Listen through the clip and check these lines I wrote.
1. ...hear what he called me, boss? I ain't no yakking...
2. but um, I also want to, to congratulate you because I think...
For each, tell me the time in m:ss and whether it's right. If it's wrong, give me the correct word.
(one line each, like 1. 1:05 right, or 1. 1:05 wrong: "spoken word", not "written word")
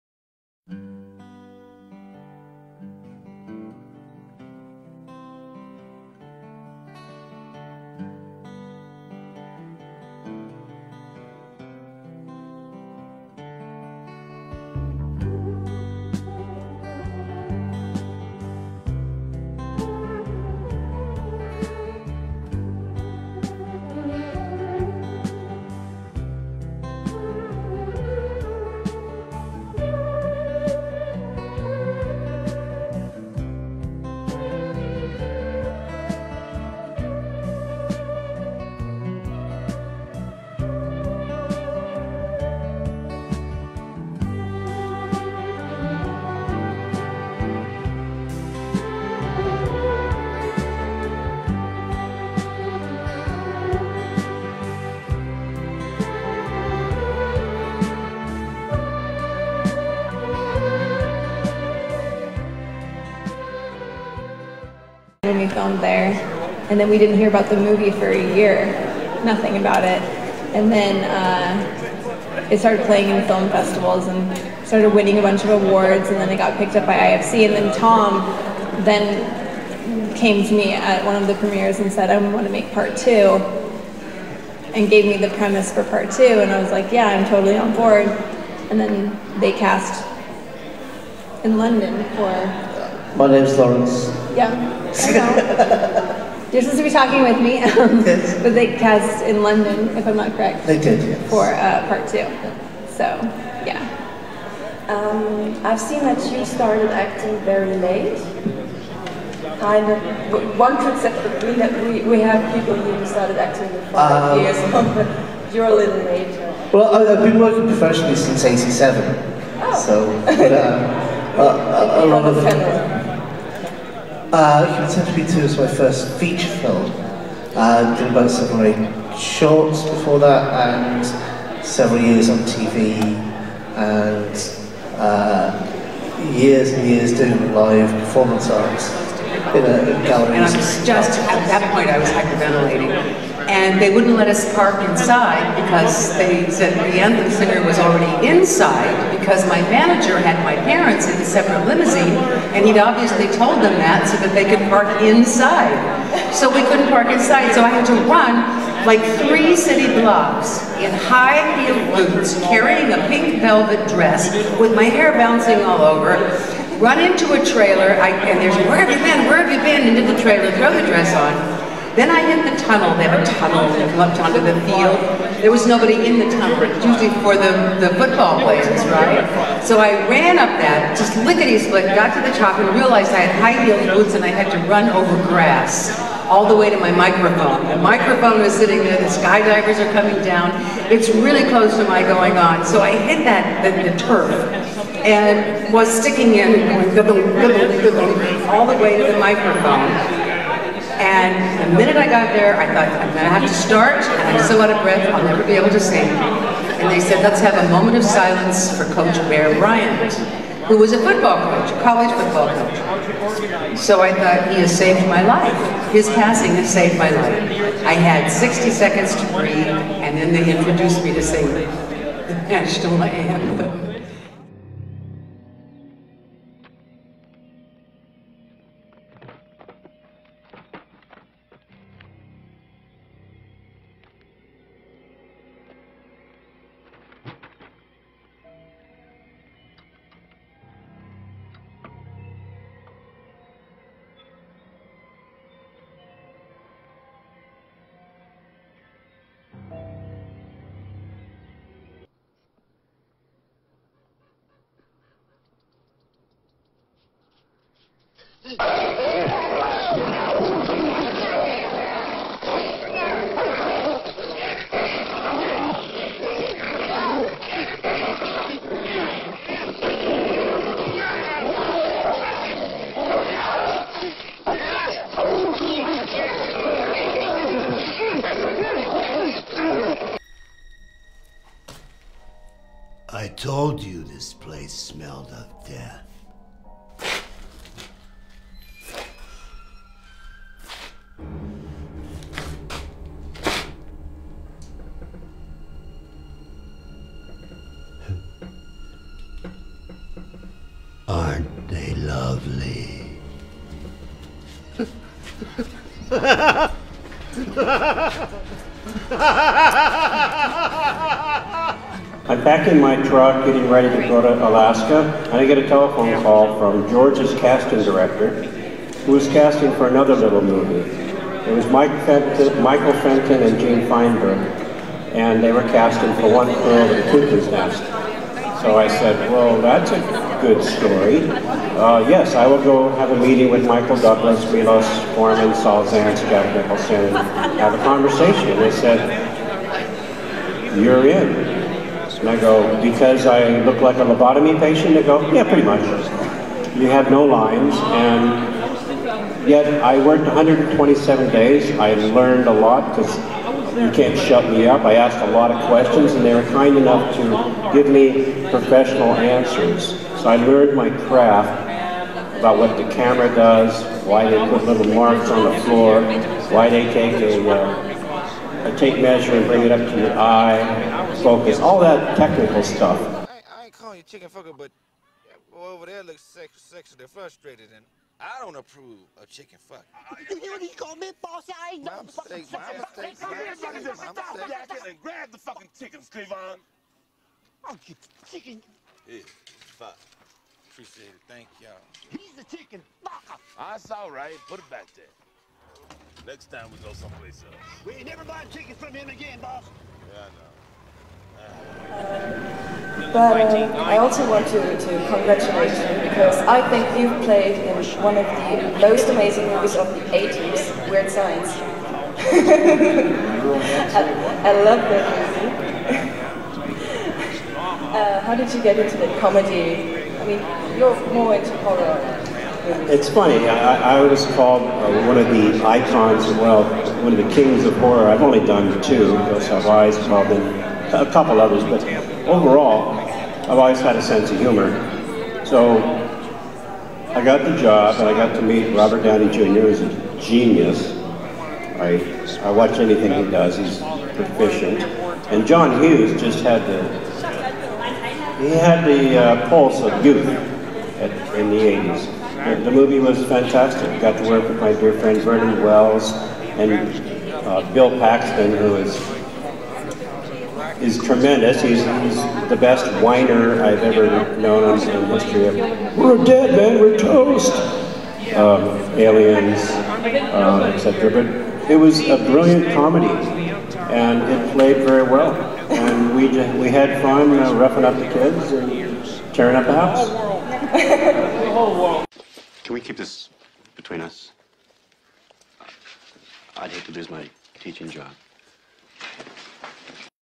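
1. 6:20 wrong: "fucking", not "yakking"
2. 6:43 right.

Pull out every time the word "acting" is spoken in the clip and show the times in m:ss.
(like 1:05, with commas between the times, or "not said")
1:46, 1:53.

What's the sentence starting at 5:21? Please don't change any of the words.
It was Mike Fenton, Michael Fenton and Jane Feinberg, and they were casting for One girl in the Cuckoo's Nest.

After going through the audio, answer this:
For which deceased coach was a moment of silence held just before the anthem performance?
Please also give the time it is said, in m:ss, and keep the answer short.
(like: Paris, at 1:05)
Bear Bryant, at 3:29.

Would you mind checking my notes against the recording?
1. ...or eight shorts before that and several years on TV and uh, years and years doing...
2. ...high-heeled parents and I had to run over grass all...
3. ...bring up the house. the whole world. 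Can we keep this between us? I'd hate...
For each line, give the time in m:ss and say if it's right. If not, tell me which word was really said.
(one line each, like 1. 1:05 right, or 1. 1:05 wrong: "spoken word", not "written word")
1. 2:08 right
2. 3:03 wrong: "boots", not "parents"
3. 7:59 wrong: "tearing", not "bring".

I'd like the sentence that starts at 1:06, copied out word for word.
And then we didn't hear about the movie for a year, nothing about it.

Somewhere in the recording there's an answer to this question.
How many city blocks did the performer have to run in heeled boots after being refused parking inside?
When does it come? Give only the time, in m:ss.
2:39.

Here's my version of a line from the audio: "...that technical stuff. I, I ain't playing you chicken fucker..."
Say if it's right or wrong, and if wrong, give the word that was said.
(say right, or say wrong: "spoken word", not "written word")
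wrong: "calling", not "playing".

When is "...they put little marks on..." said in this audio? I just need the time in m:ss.
6:04.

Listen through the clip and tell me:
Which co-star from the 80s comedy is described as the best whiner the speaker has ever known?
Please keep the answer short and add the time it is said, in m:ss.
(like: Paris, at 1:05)
Bill Paxton, at 7:37.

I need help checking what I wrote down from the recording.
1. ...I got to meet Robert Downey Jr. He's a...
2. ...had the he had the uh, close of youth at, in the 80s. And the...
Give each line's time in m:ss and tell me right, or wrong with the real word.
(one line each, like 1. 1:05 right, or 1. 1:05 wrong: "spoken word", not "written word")
1. 7:18 right
2. 7:26 wrong: "pulse", not "close".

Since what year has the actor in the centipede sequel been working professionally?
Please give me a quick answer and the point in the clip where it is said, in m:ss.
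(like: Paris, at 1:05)
1987, at 1:58.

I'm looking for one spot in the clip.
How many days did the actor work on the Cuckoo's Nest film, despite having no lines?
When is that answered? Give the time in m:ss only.
5:50.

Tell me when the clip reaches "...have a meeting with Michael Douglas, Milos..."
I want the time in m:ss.
5:32.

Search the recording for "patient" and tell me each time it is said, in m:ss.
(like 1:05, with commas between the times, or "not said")
5:44.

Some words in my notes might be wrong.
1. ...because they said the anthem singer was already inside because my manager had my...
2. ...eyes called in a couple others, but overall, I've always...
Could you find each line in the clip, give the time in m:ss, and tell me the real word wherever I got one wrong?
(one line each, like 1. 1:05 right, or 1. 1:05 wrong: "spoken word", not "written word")
1. 2:25 right
2. 7:09 right.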